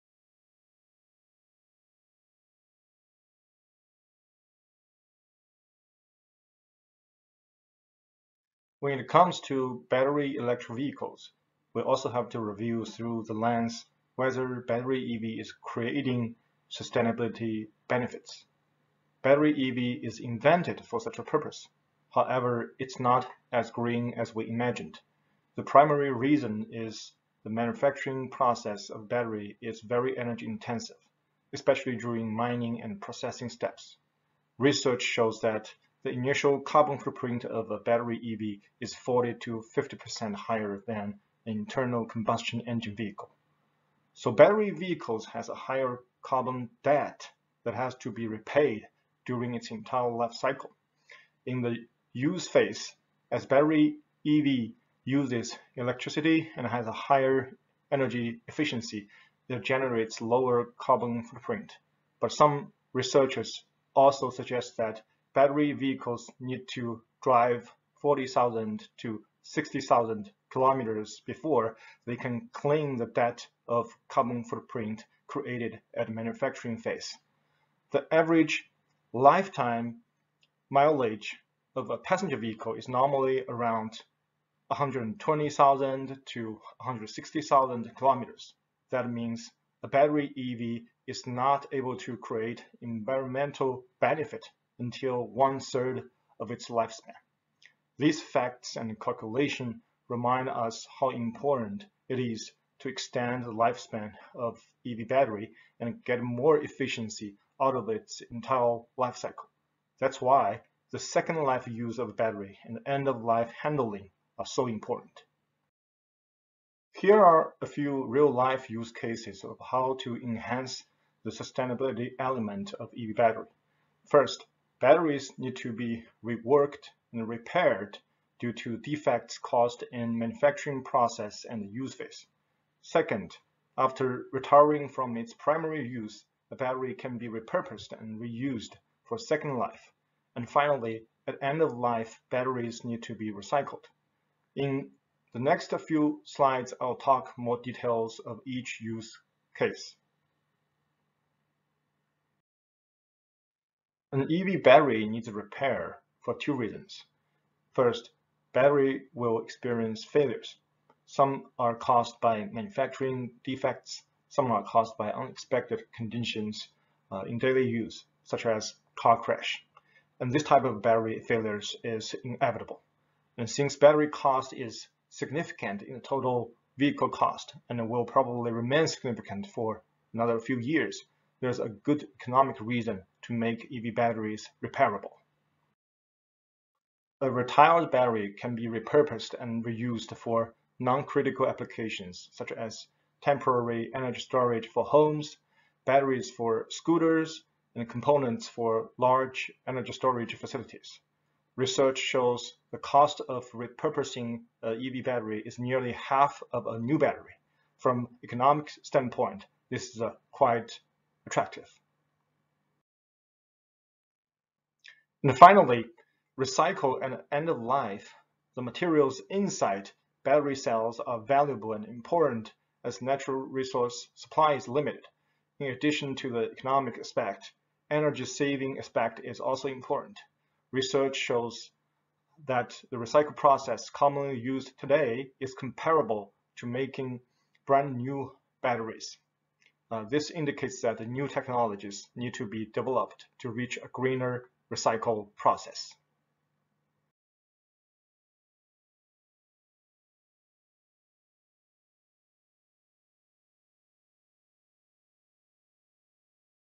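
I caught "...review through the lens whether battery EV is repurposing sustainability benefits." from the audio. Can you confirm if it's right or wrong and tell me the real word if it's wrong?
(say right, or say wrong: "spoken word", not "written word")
wrong: "creating", not "repurposing".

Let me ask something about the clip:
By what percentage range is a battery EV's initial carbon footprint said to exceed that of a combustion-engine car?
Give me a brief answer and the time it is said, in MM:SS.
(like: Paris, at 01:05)
40 to 50%, at 00:38.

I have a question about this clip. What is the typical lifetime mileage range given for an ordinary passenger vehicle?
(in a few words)
120,000 to 160,000 kilometers.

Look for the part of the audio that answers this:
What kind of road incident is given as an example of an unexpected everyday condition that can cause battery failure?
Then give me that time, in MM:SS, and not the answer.
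02:48.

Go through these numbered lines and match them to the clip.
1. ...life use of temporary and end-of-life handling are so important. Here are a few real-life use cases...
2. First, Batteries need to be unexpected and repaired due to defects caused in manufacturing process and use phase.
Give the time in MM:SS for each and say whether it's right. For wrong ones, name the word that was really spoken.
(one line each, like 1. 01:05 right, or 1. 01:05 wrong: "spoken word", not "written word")
1. 01:51 wrong: "battery", not "temporary"
2. 02:04 wrong: "reworked", not "unexpected".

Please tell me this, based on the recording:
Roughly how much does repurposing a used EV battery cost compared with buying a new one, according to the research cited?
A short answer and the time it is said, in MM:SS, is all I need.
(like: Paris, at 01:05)
nearly half, at 03:25.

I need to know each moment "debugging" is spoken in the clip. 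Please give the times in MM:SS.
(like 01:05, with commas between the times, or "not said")
not said.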